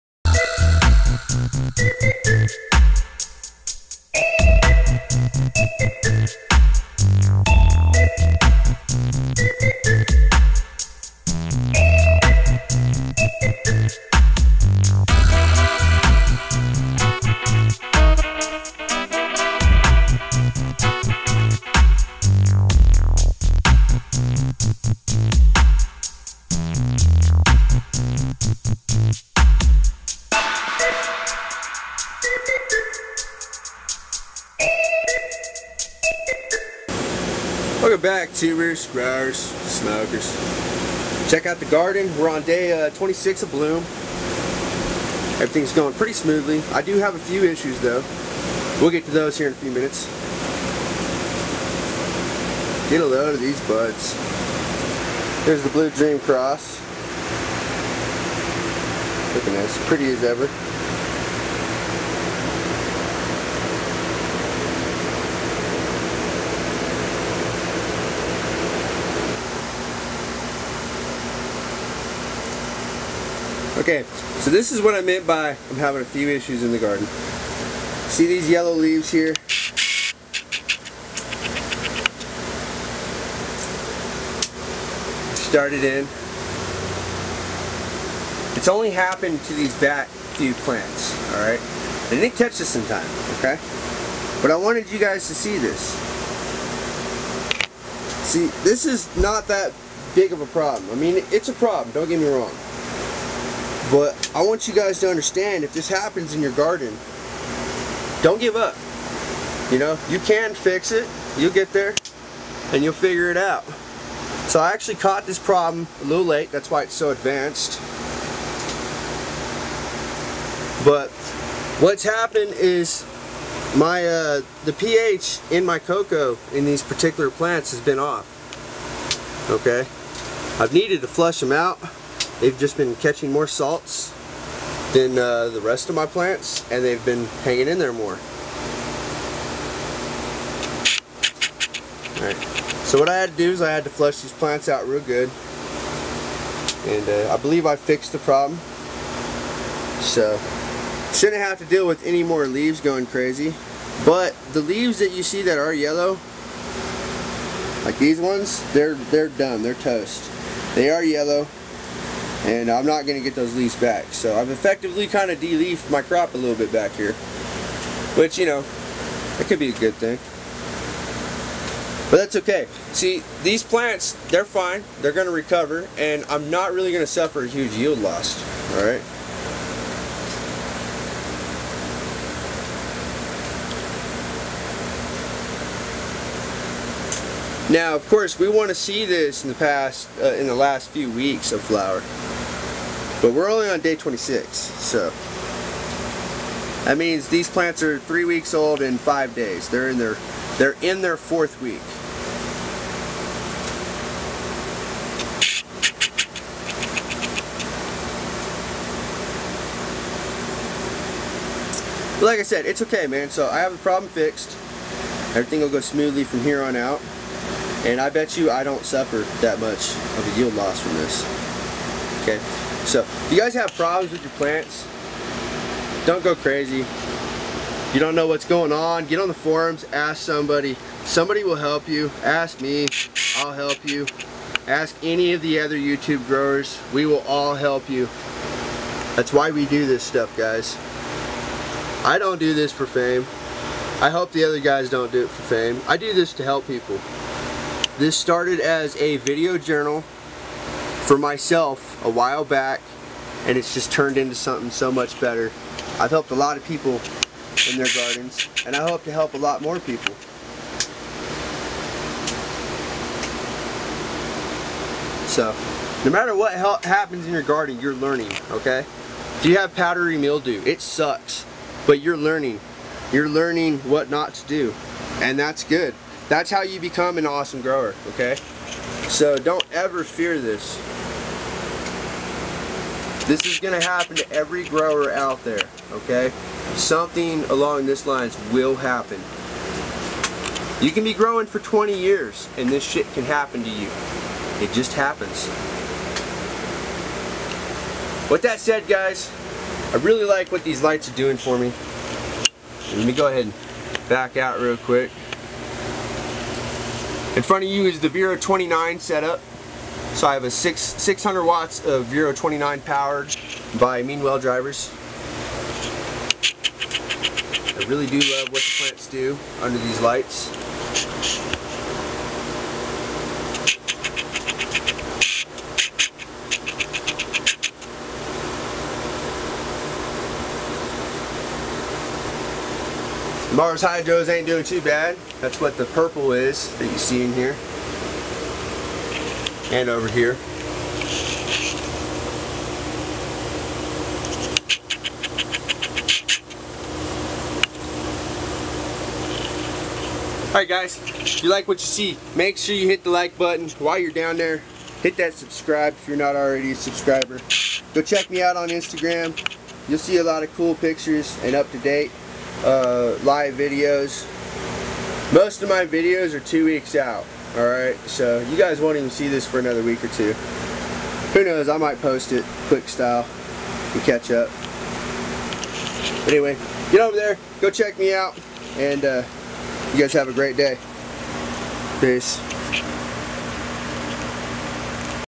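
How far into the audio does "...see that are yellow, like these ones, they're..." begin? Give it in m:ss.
2:35.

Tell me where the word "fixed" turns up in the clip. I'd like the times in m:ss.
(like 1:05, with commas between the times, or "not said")
2:27, 3:34.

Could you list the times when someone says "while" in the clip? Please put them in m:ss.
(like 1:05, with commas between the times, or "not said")
4:12, 5:53.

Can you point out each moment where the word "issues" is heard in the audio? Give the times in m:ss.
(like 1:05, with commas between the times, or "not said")
0:47, 1:16.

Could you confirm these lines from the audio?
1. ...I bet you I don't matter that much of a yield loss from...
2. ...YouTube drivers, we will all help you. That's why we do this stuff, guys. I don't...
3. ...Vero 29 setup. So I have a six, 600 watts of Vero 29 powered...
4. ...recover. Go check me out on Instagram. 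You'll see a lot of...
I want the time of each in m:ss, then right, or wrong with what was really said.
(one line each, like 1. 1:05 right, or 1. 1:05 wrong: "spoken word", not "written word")
1. 3:37 wrong: "suffer", not "matter"
2. 3:55 wrong: "growers", not "drivers"
3. 5:08 right
4. 5:56 wrong: "subscriber", not "recover".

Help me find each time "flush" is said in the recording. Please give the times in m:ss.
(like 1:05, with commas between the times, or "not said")
2:11, 2:23.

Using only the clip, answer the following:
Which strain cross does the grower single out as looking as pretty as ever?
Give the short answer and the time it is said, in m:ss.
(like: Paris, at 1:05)
Blue Dream Cross, at 0:55.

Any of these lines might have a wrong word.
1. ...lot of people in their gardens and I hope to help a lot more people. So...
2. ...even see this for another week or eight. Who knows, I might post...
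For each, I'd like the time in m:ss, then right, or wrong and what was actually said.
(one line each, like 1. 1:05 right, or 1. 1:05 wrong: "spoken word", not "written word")
1. 4:16 right
2. 6:08 wrong: "two", not "eight".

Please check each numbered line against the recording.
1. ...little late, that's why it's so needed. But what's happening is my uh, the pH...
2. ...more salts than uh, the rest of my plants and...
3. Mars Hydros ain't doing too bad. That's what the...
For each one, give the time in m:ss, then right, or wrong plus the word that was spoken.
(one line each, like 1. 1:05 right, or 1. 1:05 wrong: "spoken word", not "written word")
1. 1:56 wrong: "advanced", not "needed"
2. 2:13 right
3. 5:33 right.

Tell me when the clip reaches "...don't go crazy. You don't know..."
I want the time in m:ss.
3:46.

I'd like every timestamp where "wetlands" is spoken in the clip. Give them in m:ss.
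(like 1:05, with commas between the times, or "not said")
not said.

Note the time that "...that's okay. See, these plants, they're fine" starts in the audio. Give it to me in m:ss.
2:52.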